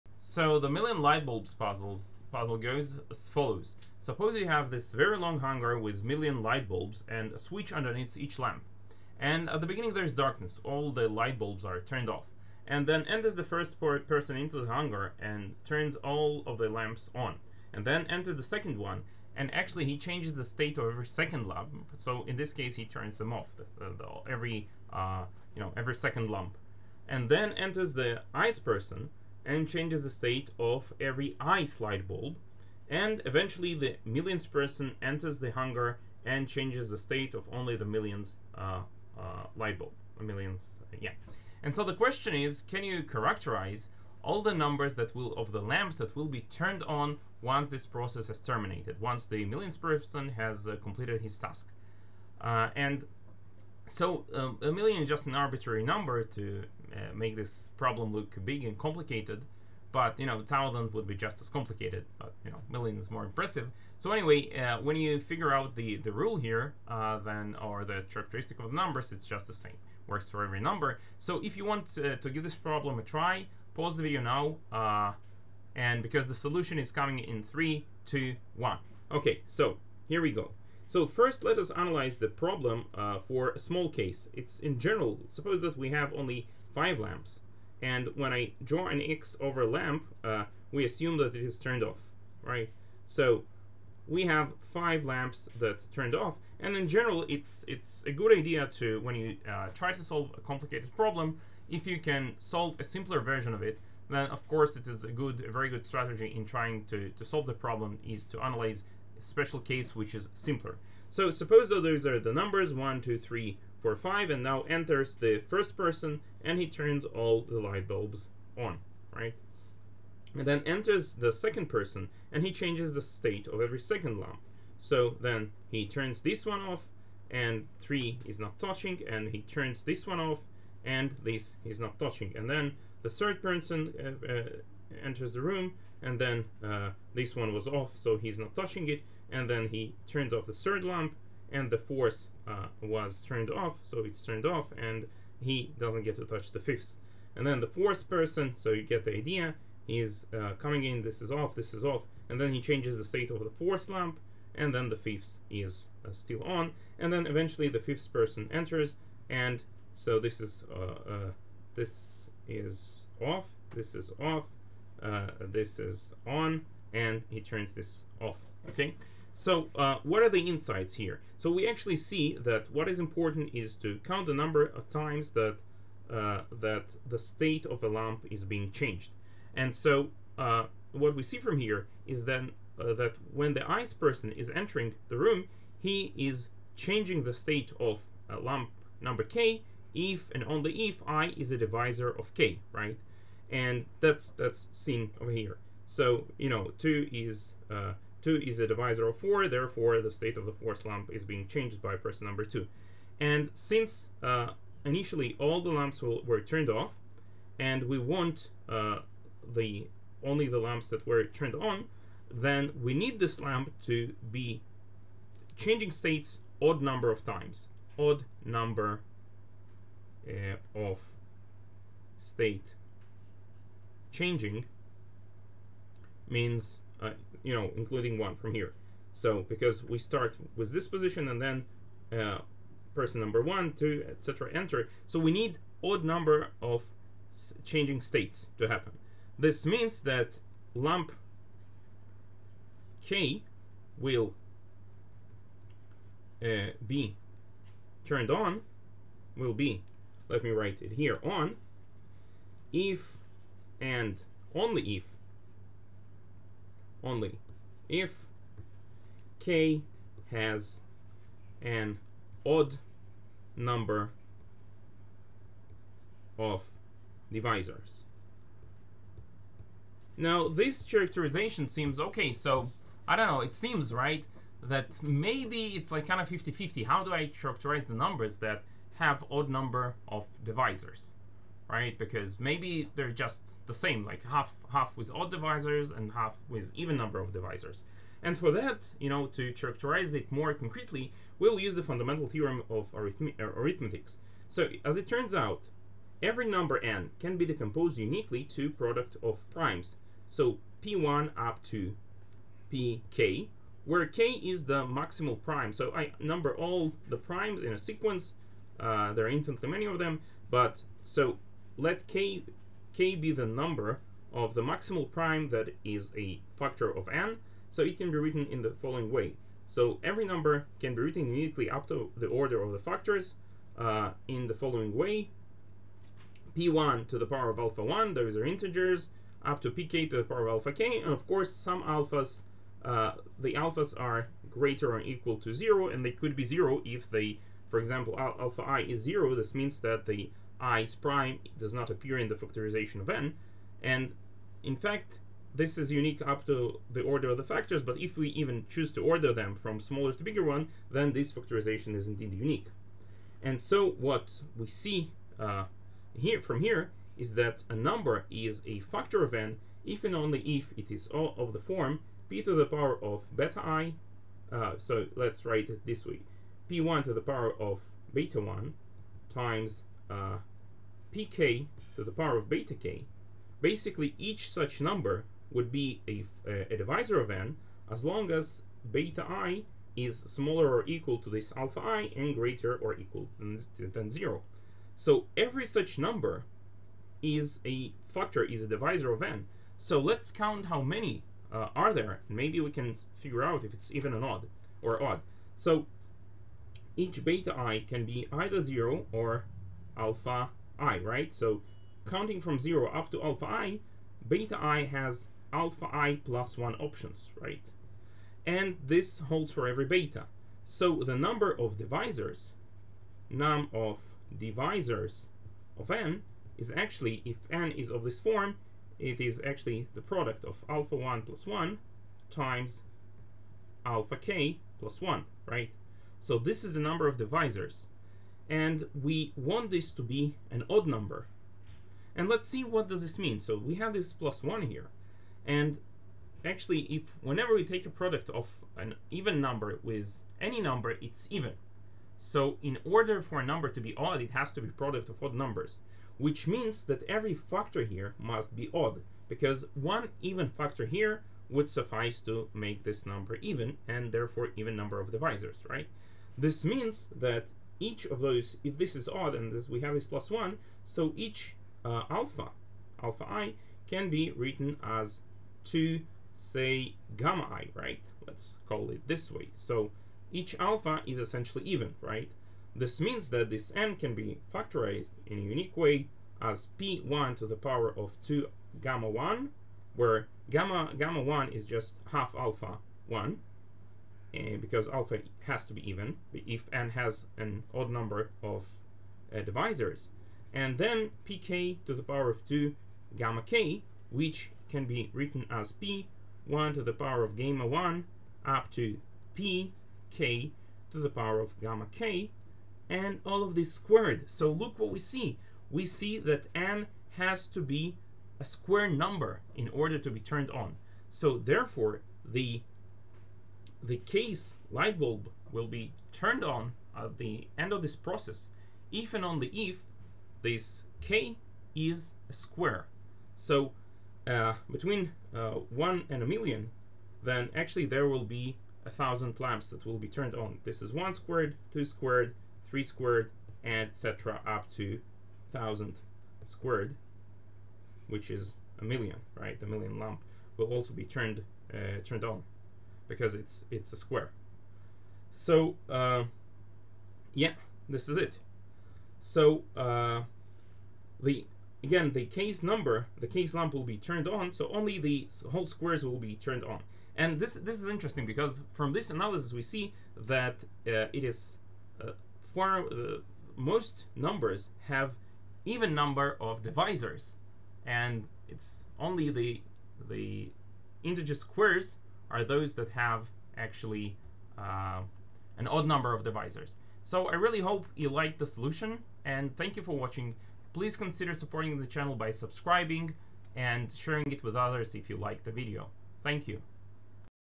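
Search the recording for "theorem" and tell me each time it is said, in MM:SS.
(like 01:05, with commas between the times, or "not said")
04:52.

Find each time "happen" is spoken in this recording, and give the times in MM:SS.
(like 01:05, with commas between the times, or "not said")
03:58.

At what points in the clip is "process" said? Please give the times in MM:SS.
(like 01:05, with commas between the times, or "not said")
00:47, 08:37.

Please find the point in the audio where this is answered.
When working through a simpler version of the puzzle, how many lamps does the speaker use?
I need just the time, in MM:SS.
01:26.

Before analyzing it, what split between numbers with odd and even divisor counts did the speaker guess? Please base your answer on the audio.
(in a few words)
50 50.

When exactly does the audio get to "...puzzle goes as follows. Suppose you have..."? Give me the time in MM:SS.
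00:02.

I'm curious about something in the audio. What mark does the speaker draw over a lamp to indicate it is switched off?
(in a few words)
An X.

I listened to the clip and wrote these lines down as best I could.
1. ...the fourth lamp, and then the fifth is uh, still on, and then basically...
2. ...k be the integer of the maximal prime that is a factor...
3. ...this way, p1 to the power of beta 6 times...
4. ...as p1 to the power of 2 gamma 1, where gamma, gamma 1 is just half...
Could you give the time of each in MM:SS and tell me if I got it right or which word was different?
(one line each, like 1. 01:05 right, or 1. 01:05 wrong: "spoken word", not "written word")
1. 02:33 wrong: "eventually", not "basically"
2. 05:12 wrong: "number", not "integer"
3. 06:05 wrong: "1", not "6"
4. 07:56 right.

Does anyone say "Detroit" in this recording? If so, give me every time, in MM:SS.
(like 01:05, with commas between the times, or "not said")
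not said.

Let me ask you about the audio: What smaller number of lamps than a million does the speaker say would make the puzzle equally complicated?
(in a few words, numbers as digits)
Thousands.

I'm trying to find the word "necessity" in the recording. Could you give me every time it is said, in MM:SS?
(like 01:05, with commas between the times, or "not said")
not said.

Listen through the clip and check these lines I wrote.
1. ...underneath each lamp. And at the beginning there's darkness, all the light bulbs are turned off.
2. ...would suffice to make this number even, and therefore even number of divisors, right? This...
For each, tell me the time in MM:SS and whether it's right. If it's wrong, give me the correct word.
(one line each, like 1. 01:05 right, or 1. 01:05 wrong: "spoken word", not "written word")
1. 00:07 right
2. 07:31 right.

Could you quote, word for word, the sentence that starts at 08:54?
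up to 1000 squared, which is a million, right?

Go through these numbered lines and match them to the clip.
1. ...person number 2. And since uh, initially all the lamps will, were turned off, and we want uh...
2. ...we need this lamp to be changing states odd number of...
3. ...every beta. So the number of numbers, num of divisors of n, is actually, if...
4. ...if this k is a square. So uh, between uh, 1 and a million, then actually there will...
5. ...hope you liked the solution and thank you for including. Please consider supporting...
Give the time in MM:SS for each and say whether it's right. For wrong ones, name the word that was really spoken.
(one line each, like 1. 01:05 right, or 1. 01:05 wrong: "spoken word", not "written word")
1. 03:21 right
2. 03:32 right
3. 06:49 wrong: "divisors", not "numbers"
4. 08:39 right
5. 09:37 wrong: "watching", not "including".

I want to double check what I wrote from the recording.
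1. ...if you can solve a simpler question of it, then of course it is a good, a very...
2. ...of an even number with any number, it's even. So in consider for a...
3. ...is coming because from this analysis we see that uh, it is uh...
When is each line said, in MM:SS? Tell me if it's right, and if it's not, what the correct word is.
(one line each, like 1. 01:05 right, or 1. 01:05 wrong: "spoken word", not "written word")
1. 01:41 wrong: "version", not "question"
2. 07:18 wrong: "order", not "consider"
3. 09:17 wrong: "interesting", not "coming".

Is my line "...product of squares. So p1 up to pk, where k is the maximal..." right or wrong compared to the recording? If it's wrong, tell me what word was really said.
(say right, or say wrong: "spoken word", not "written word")
wrong: "primes", not "squares".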